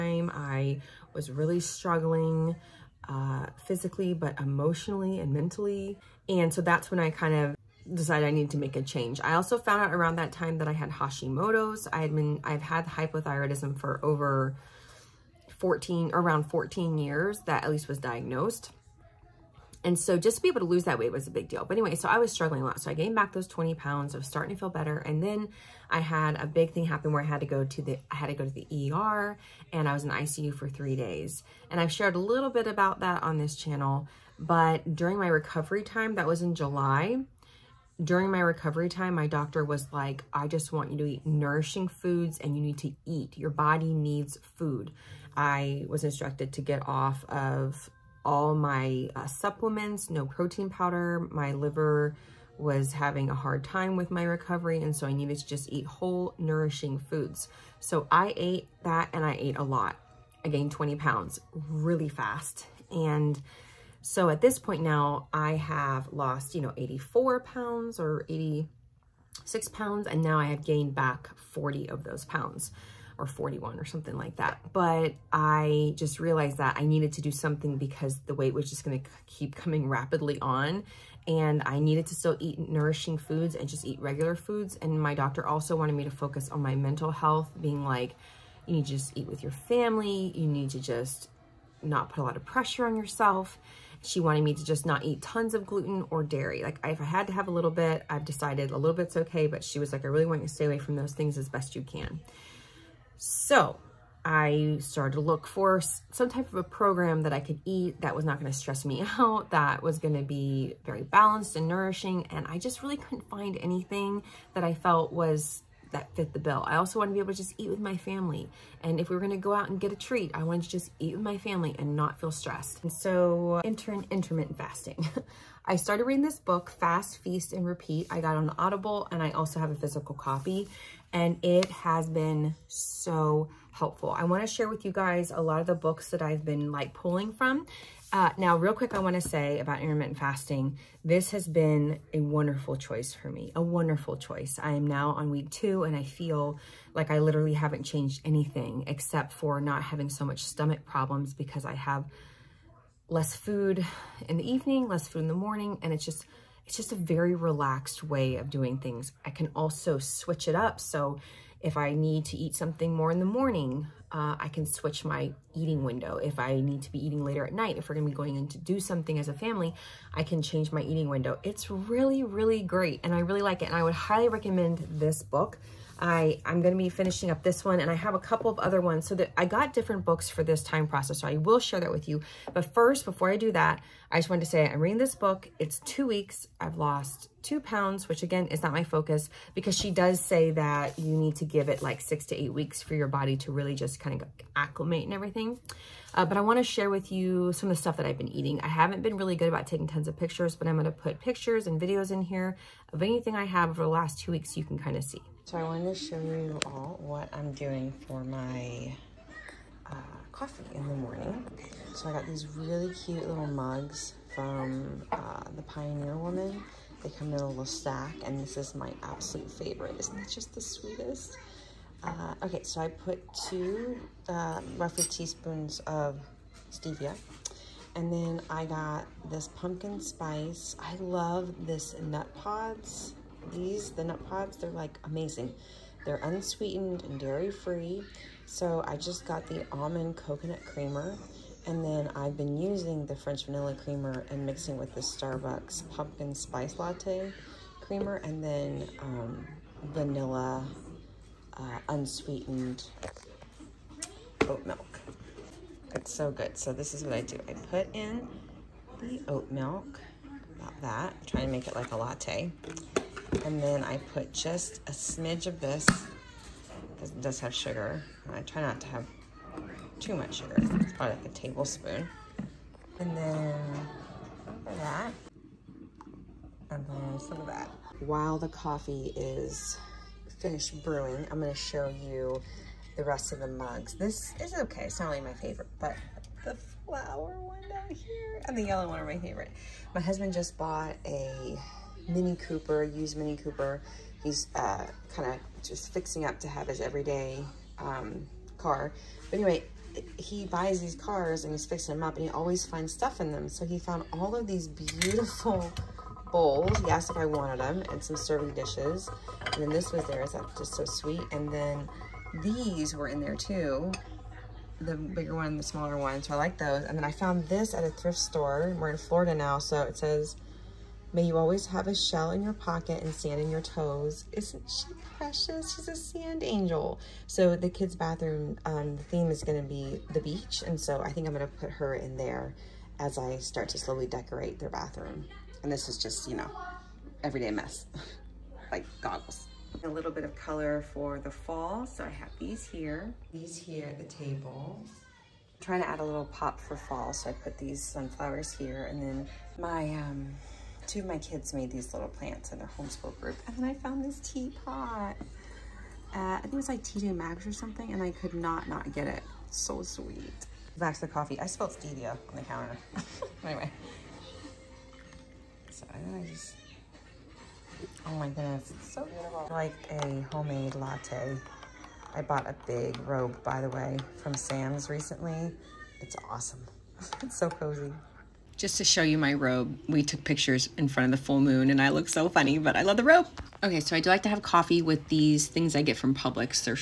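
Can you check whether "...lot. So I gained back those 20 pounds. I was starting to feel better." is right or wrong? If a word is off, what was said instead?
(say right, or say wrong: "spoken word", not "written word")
right.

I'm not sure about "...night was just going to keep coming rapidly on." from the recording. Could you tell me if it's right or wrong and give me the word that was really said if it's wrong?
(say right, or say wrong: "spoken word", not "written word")
wrong: "weight", not "night".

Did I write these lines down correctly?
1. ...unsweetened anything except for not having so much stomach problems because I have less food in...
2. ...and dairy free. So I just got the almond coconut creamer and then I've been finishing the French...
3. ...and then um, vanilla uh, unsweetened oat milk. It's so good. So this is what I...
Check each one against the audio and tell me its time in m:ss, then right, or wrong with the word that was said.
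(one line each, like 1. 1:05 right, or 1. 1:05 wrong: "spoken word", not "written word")
1. 2:27 wrong: "changed", not "unsweetened"
2. 3:57 wrong: "using", not "finishing"
3. 4:08 right.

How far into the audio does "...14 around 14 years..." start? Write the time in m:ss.
0:15.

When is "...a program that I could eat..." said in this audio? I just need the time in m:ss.
1:46.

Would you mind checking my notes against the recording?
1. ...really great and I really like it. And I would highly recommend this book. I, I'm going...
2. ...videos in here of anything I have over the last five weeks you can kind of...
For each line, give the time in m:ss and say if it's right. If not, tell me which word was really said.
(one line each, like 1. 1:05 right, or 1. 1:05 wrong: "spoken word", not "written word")
1. 2:52 right
2. 3:21 wrong: "two", not "five".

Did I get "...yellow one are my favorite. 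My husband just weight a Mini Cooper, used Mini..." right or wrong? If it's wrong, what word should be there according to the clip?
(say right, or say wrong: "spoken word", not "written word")
wrong: "bought", not "weight".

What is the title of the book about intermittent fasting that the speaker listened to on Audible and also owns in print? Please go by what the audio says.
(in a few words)
Fast, Feast, and Repeat.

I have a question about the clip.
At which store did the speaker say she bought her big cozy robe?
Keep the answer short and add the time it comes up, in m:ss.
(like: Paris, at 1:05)
Sam's, at 6:14.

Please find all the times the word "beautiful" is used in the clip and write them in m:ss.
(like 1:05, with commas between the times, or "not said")
5:04, 6:09.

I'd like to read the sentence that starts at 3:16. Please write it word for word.
Uh, but I want to share with you some of the stuff that I've been eating.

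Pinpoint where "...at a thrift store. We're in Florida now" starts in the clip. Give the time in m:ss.
5:17.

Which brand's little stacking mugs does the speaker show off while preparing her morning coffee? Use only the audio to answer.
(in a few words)
The Pioneer Woman.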